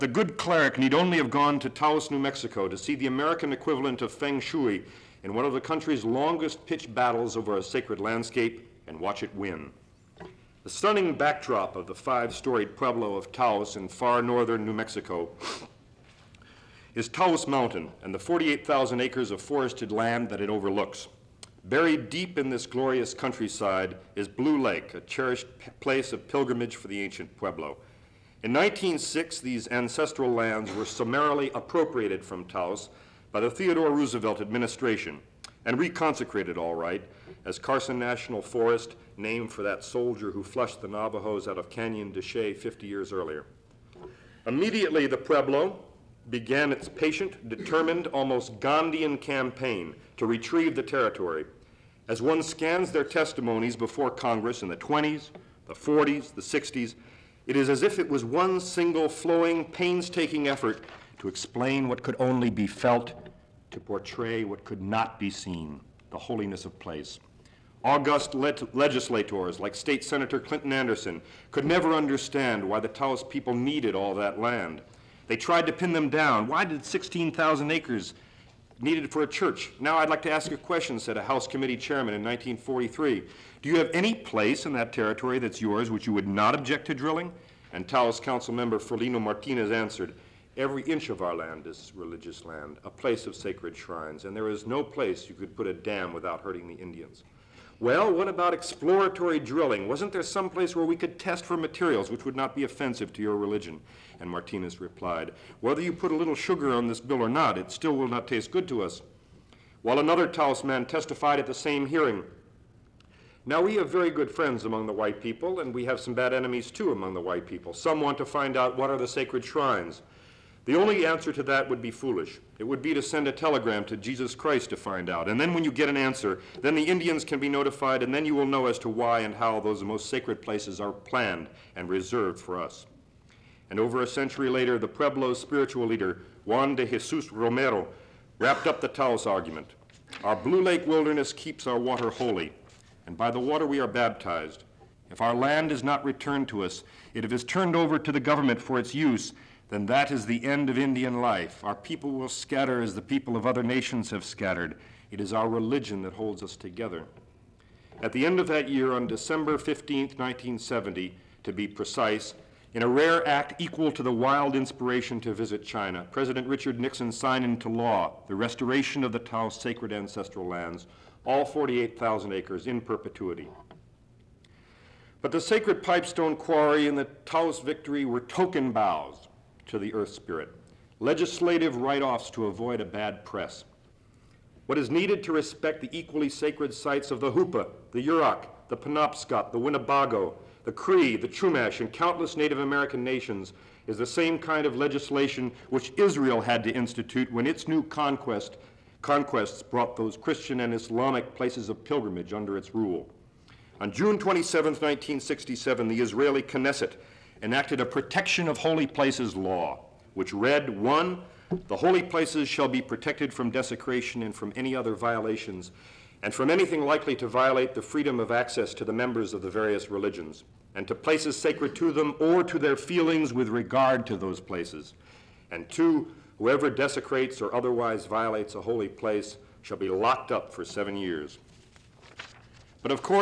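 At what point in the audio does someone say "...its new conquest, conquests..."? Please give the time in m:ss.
3:17.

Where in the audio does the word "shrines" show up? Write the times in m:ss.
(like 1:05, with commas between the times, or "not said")
1:33, 1:59.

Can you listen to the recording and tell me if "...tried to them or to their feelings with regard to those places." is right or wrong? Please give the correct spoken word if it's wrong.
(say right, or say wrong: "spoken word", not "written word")
wrong: "sacred", not "tried".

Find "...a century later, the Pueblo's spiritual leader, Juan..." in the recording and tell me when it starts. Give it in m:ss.
2:14.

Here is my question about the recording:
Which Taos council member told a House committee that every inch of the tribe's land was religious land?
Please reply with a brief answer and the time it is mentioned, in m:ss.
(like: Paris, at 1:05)
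Ferlino Martinez, at 1:28.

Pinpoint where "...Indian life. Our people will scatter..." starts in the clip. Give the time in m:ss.
2:30.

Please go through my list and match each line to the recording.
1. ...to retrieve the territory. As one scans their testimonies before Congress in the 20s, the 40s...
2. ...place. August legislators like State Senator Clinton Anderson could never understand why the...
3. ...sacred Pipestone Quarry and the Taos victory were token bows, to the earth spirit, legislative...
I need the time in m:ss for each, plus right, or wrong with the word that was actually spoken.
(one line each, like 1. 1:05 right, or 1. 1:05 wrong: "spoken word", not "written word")
1. 0:50 right
2. 1:06 right
3. 2:55 right.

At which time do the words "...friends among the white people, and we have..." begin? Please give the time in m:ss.
1:54.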